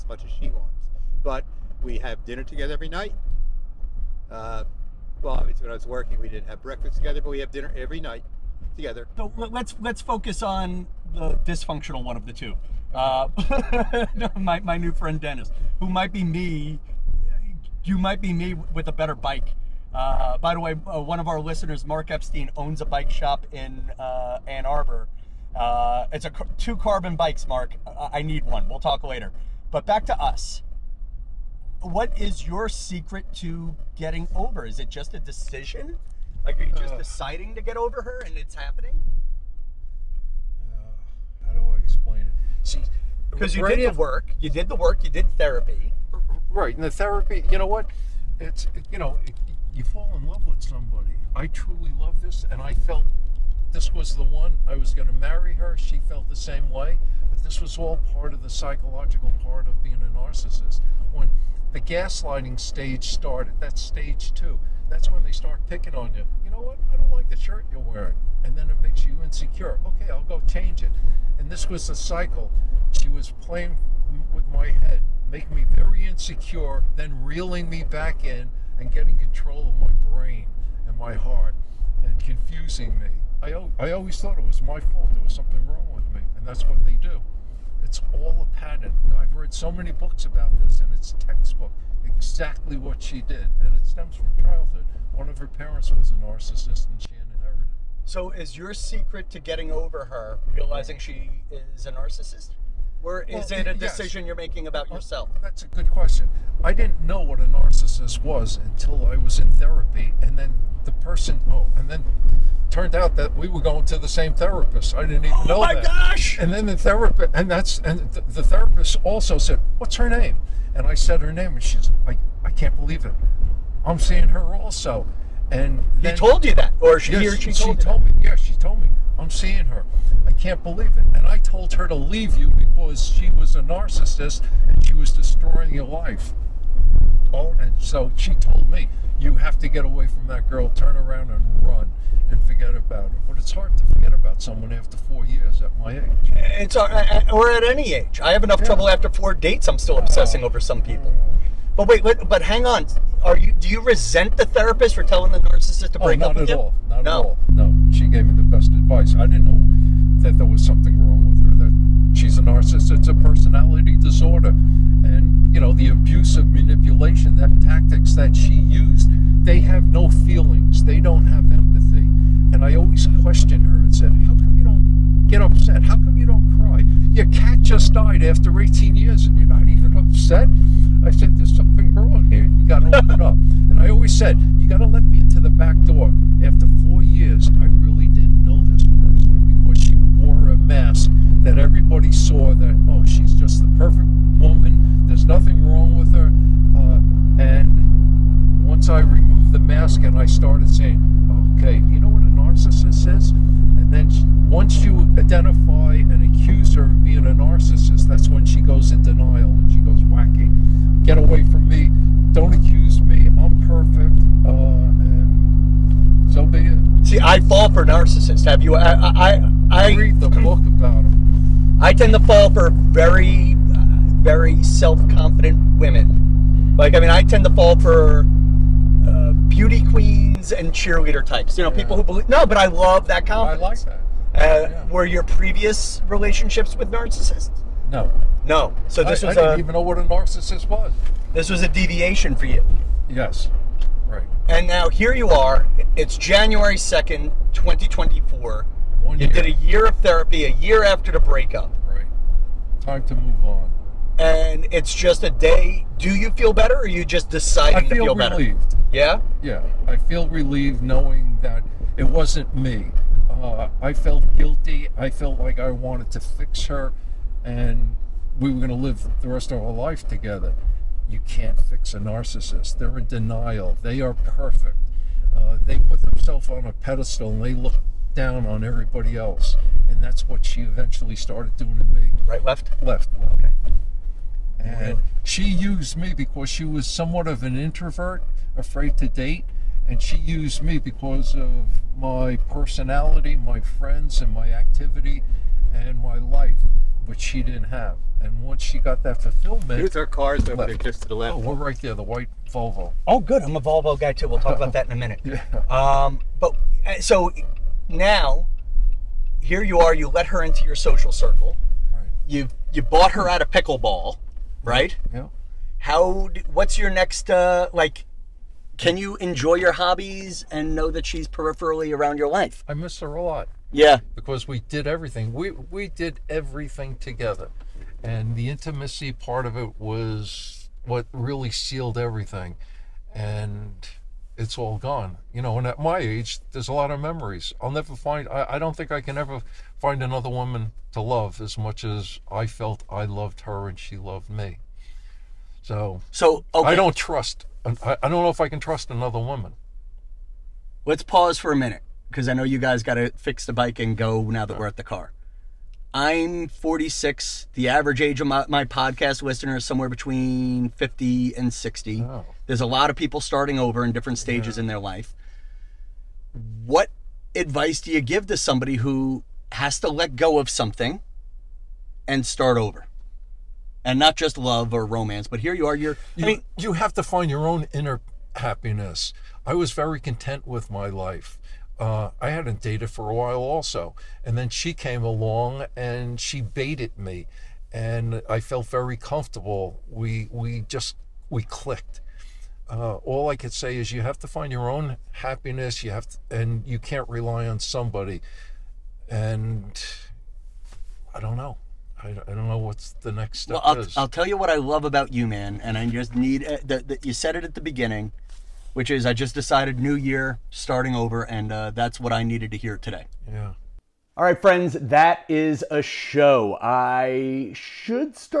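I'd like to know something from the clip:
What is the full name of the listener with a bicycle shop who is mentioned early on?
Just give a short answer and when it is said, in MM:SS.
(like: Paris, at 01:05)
Mark Epstein, at 00:21.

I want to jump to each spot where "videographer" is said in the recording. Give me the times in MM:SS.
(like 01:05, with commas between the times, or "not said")
not said.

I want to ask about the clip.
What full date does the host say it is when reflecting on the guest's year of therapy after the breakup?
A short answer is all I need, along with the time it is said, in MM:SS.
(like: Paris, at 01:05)
January 2, 2024, at 04:06.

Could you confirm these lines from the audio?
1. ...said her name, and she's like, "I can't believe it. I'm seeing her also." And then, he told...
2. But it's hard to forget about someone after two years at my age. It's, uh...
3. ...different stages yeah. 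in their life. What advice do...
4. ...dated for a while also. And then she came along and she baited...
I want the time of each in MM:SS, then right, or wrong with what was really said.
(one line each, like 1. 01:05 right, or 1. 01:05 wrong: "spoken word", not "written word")
1. 02:00 right
2. 02:23 wrong: "four", not "two"
3. 06:03 right
4. 06:22 right.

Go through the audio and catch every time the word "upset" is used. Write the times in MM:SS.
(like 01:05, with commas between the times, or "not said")
02:55, 02:59.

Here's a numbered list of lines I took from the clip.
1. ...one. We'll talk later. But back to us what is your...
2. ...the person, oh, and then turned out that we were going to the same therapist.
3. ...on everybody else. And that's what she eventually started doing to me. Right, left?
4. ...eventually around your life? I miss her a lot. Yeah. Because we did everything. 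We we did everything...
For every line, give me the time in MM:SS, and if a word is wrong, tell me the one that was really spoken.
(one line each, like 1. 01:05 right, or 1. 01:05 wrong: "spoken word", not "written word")
1. 00:28 right
2. 01:50 right
3. 04:38 right
4. 05:21 wrong: "peripherally", not "eventually".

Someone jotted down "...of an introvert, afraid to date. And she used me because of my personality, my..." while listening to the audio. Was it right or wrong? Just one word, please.
right.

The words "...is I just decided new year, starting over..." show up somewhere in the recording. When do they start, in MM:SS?
06:48.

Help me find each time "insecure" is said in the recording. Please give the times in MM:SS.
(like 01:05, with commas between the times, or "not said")
01:09, 01:16.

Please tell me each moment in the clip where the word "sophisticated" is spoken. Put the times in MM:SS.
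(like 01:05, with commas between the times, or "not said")
not said.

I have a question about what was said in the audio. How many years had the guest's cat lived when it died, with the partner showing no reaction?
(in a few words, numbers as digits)
18.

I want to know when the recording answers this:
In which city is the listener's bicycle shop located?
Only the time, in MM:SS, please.
00:24.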